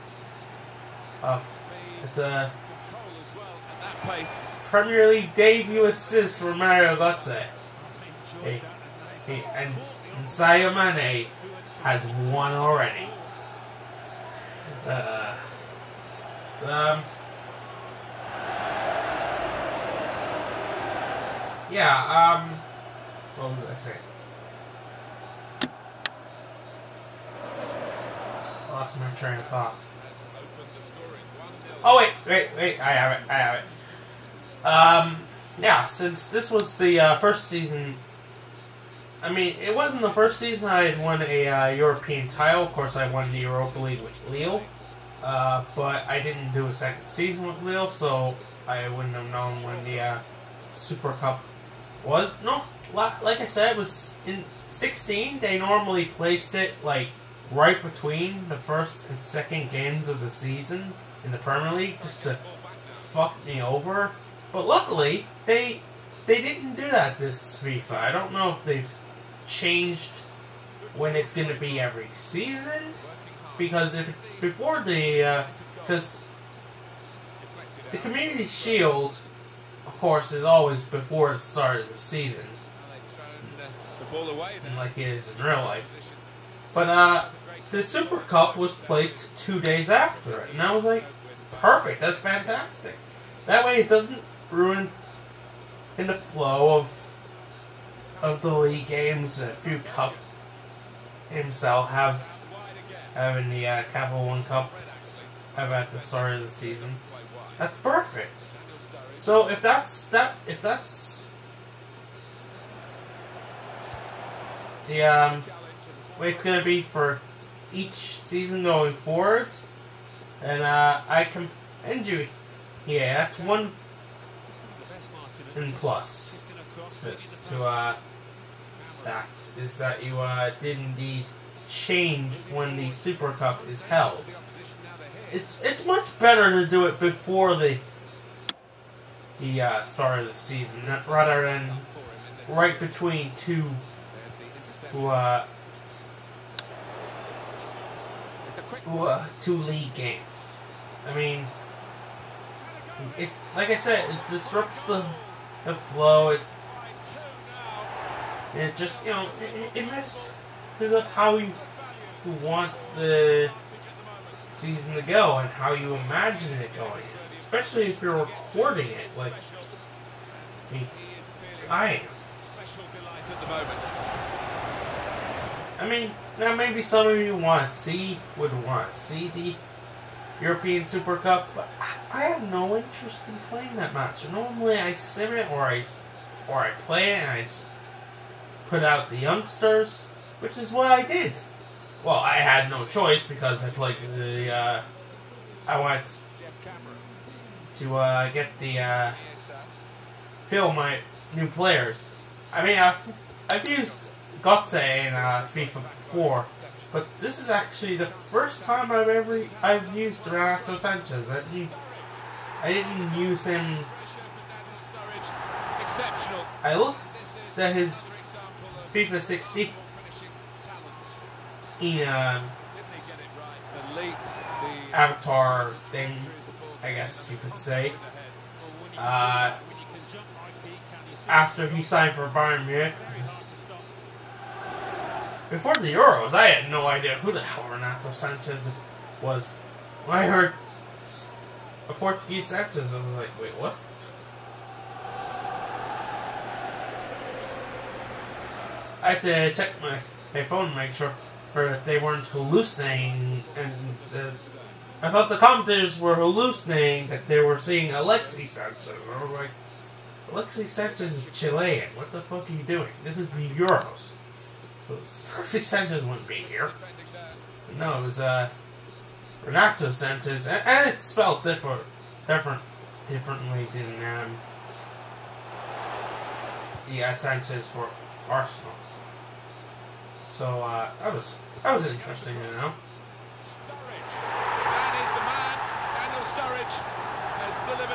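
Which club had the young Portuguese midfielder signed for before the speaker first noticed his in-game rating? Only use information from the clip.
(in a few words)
Bayern Munich.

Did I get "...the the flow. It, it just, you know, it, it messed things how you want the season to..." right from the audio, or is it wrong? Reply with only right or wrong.
right.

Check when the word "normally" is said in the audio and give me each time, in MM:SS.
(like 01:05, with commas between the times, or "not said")
00:55, 03:04.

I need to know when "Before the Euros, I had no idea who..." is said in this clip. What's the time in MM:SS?
03:55.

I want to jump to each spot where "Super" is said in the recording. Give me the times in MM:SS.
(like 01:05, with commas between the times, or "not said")
00:50, 01:27, 02:12, 03:00.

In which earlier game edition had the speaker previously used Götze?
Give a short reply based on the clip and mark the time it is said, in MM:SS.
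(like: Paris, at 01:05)
FIFA 4, at 03:25.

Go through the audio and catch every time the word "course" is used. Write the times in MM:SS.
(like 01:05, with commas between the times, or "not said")
00:42, 01:19.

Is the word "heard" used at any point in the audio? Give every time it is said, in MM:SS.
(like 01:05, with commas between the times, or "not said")
04:00.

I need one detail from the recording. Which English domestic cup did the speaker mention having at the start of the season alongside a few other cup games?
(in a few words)
Capital One Cup.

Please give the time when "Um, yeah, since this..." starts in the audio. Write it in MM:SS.
00:34.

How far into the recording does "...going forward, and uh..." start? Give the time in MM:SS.
01:58.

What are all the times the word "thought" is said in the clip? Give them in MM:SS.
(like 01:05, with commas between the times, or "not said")
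00:29, 04:15.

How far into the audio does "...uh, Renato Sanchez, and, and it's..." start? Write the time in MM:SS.
04:28.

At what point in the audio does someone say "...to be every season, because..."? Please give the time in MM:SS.
01:11.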